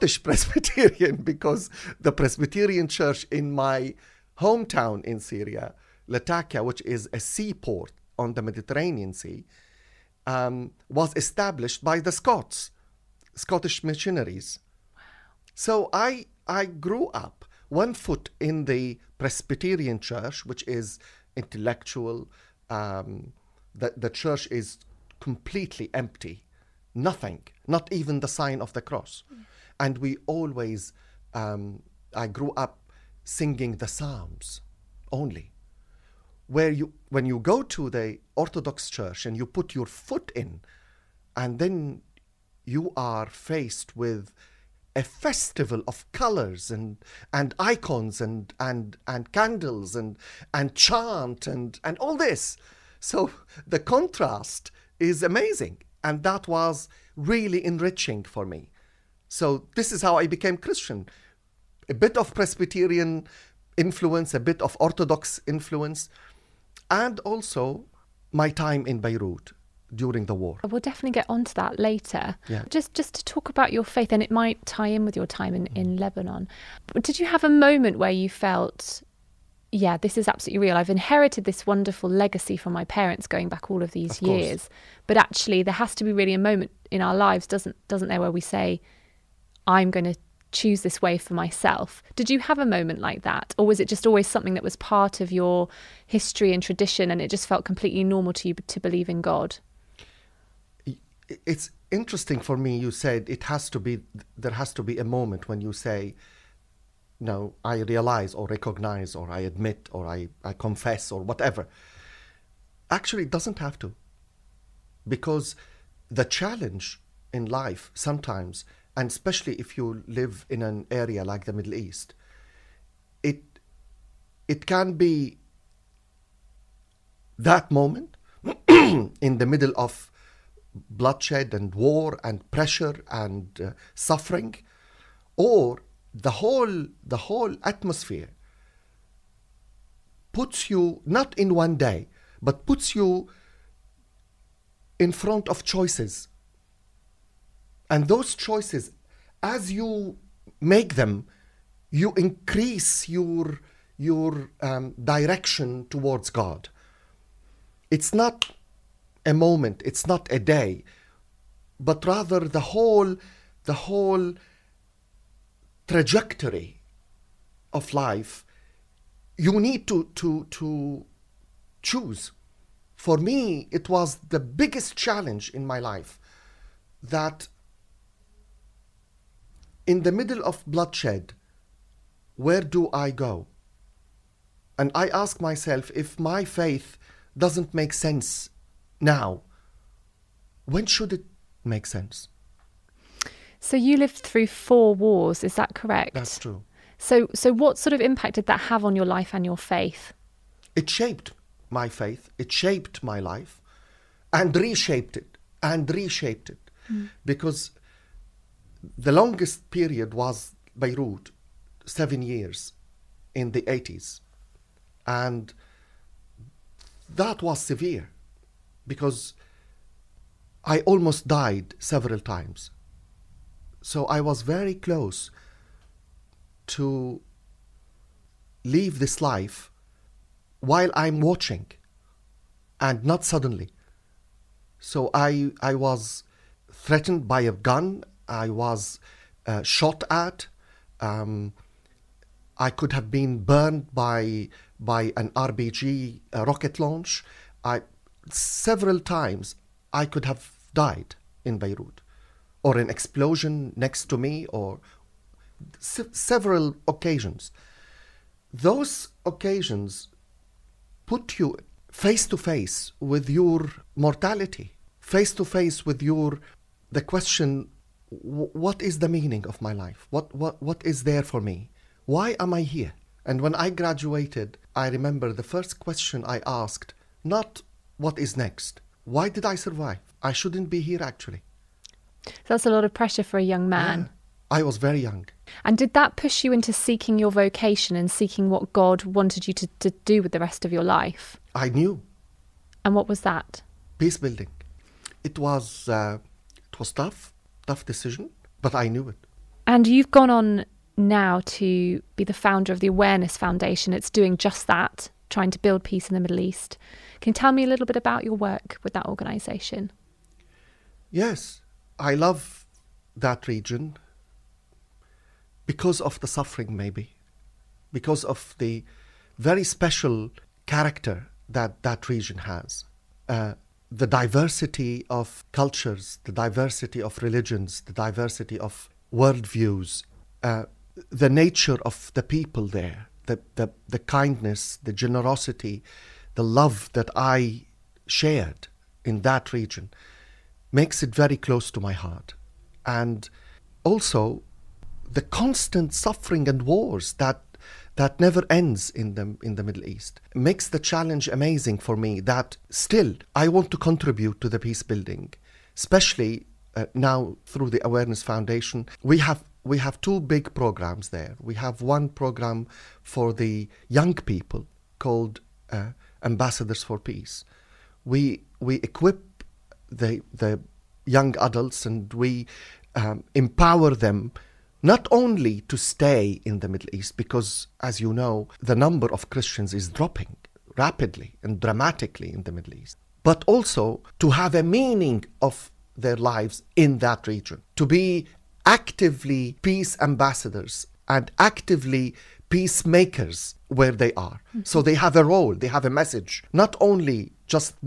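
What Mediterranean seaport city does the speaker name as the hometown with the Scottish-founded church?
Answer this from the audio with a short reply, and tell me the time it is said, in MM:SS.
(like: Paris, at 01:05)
Latakia, at 00:06.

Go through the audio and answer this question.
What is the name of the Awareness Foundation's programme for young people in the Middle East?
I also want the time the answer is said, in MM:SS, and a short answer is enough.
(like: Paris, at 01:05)
Ambassadors for Peace, at 06:06.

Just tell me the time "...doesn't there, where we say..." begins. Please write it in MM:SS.
01:27.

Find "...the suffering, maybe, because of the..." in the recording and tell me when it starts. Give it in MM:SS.
05:16.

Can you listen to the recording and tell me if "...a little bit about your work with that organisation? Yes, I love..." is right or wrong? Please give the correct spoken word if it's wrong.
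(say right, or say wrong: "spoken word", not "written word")
right.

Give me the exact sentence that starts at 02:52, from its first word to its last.
For me, it was the biggest challenge in my life that in the middle of bloodshed, where do I go?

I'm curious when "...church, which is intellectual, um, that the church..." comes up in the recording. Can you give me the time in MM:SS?
00:19.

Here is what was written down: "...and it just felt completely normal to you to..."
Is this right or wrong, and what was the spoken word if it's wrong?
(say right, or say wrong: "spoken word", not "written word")
right.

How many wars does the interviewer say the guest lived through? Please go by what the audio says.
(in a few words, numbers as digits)
4.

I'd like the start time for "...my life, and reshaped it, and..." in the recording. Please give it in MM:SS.
03:23.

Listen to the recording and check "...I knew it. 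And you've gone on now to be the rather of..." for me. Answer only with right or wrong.
wrong.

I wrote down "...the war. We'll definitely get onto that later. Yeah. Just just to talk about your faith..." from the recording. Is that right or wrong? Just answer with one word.
right.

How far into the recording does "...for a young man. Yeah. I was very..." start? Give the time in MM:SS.
04:43.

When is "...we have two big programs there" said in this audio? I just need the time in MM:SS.
05:59.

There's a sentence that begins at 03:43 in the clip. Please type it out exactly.
So I was very close to leave this life while I'm watching and not suddenly.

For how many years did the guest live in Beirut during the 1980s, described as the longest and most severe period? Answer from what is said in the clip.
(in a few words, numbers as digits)
7.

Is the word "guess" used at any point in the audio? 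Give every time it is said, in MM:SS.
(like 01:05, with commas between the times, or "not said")
not said.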